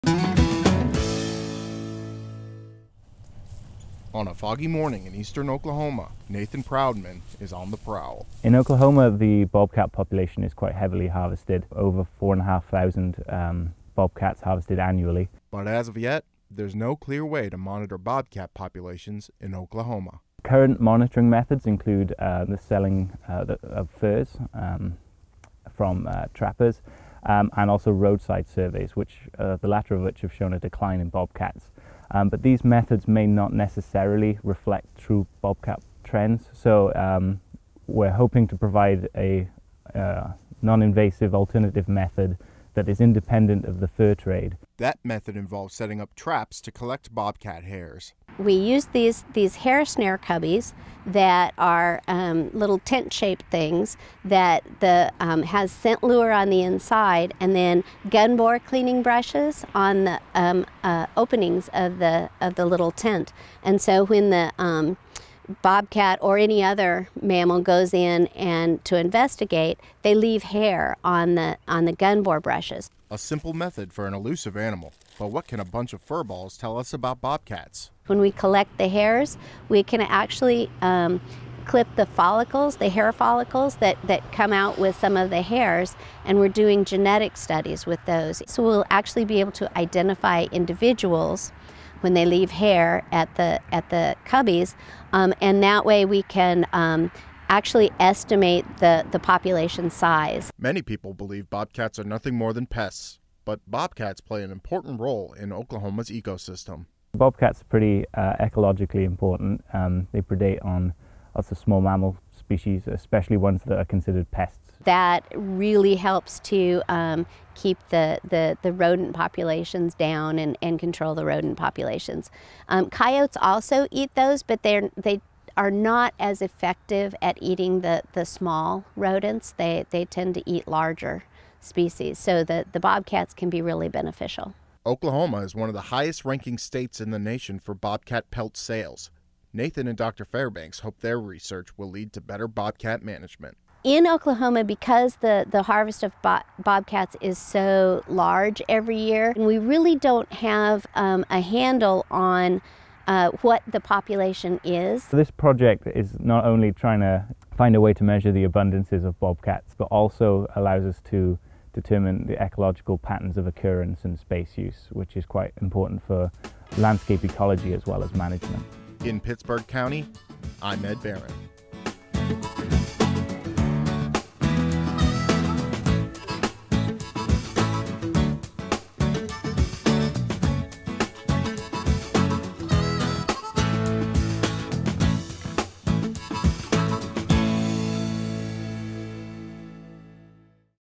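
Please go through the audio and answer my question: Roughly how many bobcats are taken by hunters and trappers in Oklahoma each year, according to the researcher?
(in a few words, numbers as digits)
over 4,500.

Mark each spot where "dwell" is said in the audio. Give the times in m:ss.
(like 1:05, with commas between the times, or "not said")
not said.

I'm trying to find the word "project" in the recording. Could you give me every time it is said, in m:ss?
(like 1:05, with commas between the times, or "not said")
2:35.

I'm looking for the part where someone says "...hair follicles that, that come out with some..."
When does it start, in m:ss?
1:22.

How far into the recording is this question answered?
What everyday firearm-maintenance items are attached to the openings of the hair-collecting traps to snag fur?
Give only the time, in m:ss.
0:58.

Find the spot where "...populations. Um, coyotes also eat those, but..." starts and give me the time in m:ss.
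2:01.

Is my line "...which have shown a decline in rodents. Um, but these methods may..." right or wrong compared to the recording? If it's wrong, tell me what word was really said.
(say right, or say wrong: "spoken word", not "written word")
wrong: "bobcats", not "rodents".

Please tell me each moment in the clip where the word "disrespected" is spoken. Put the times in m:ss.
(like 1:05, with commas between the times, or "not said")
not said.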